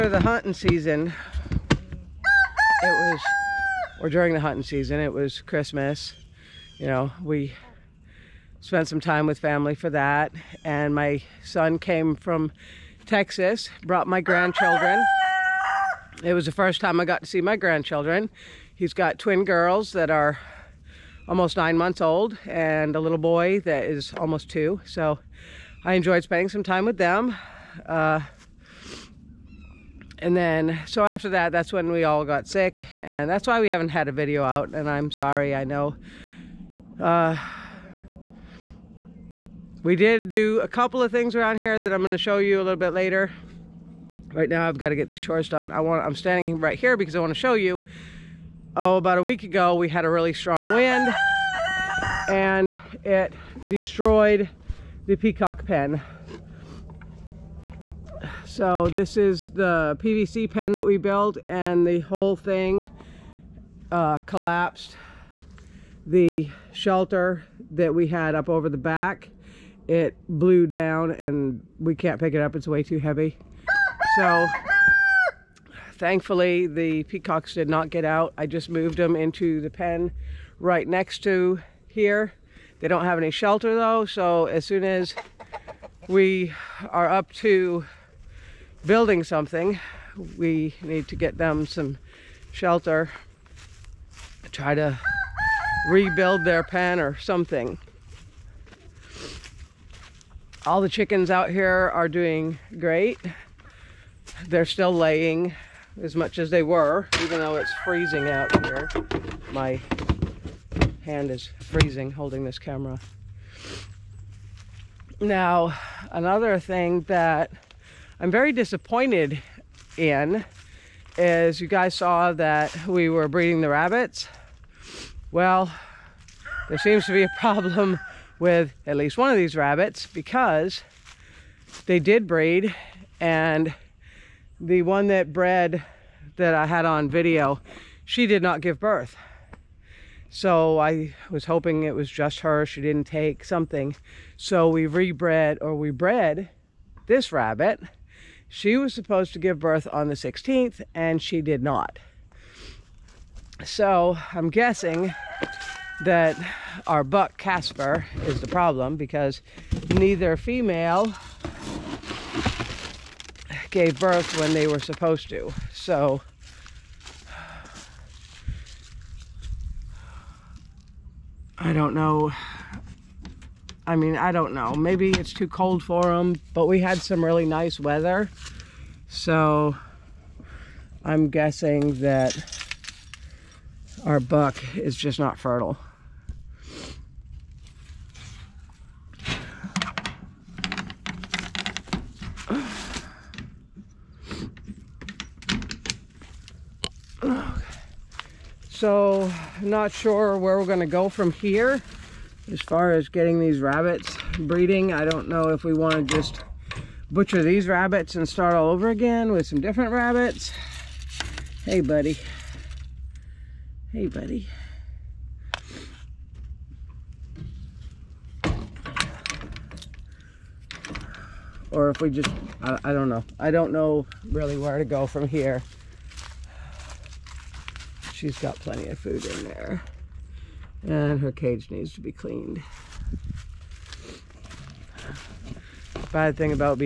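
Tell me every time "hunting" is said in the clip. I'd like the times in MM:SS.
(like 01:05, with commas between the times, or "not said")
00:00, 00:04.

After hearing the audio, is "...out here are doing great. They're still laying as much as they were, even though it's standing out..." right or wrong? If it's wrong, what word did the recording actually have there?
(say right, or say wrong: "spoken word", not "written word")
wrong: "freezing", not "standing".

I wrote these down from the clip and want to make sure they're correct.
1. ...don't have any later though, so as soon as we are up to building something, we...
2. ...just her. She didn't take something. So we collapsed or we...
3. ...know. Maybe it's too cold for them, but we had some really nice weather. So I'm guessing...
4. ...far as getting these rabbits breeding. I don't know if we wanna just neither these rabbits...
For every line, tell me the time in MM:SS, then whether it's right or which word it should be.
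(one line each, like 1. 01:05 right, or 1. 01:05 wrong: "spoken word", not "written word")
1. 01:22 wrong: "shelter", not "later"
2. 02:22 wrong: "rebred", not "collapsed"
3. 02:54 right
4. 03:22 wrong: "butcher", not "neither".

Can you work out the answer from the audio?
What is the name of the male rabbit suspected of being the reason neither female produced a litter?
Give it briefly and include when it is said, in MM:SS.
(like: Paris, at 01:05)
Casper, at 02:37.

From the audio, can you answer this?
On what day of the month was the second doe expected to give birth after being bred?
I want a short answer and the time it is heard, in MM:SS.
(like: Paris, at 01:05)
16th, at 02:30.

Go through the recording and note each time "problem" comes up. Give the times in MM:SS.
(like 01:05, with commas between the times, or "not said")
02:07, 02:38.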